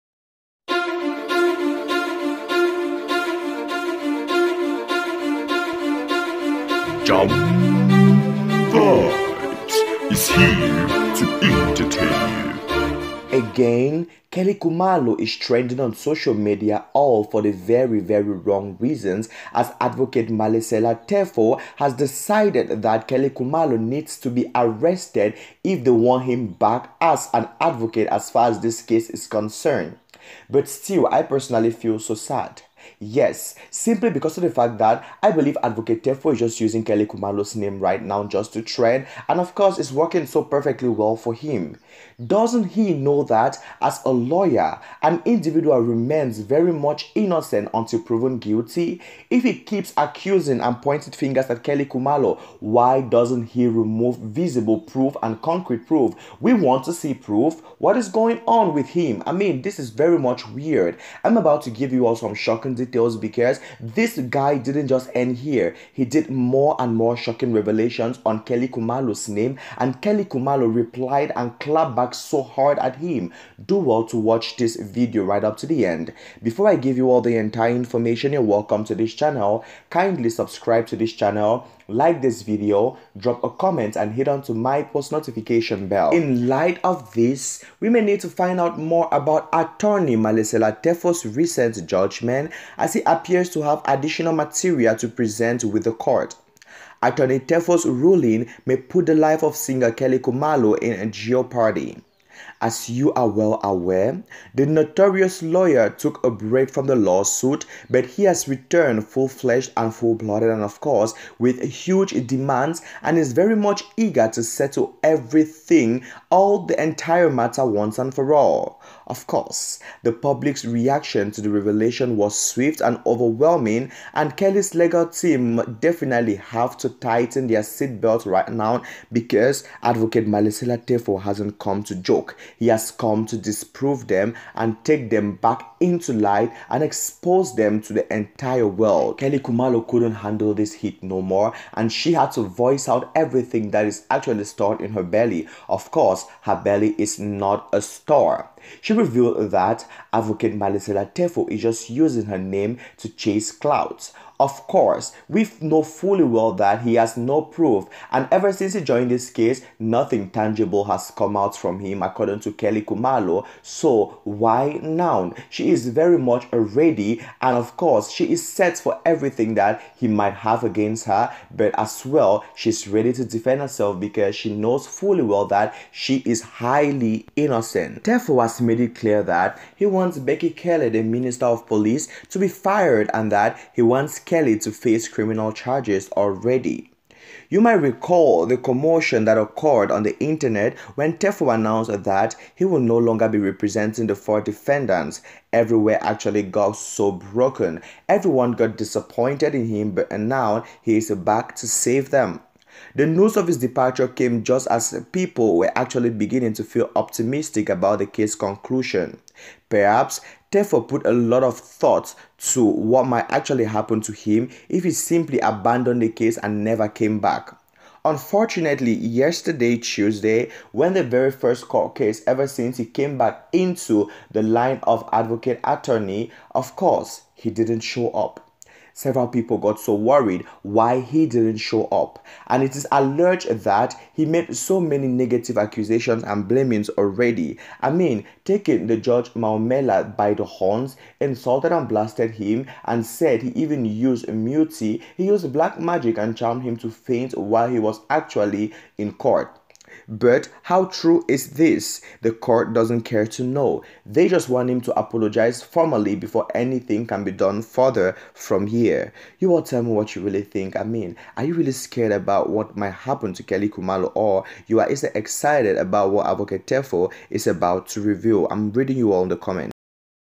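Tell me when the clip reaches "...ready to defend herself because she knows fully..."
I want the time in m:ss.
2:52.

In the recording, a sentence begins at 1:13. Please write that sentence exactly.
Do well to watch this video right up to the end.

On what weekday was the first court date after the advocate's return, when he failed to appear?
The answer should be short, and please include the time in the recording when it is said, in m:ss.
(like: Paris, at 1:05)
Tuesday, at 3:39.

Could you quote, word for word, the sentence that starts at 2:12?
He has come to disprove them and take them back into light and expose them to the entire world.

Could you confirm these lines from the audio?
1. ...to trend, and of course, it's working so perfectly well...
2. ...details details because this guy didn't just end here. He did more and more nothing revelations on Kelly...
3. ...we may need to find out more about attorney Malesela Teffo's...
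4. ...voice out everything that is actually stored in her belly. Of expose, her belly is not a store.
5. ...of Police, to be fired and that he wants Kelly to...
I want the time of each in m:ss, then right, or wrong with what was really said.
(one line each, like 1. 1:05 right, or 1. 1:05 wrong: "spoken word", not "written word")
1. 0:38 right
2. 1:02 wrong: "shocking", not "nothing"
3. 1:27 right
4. 2:22 wrong: "course", not "expose"
5. 3:01 right.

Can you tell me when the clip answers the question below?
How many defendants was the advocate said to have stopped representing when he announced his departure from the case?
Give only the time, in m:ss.
3:14.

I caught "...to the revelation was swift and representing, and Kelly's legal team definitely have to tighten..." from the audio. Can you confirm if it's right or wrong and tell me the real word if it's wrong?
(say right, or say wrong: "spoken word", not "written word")
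wrong: "overwhelming", not "representing".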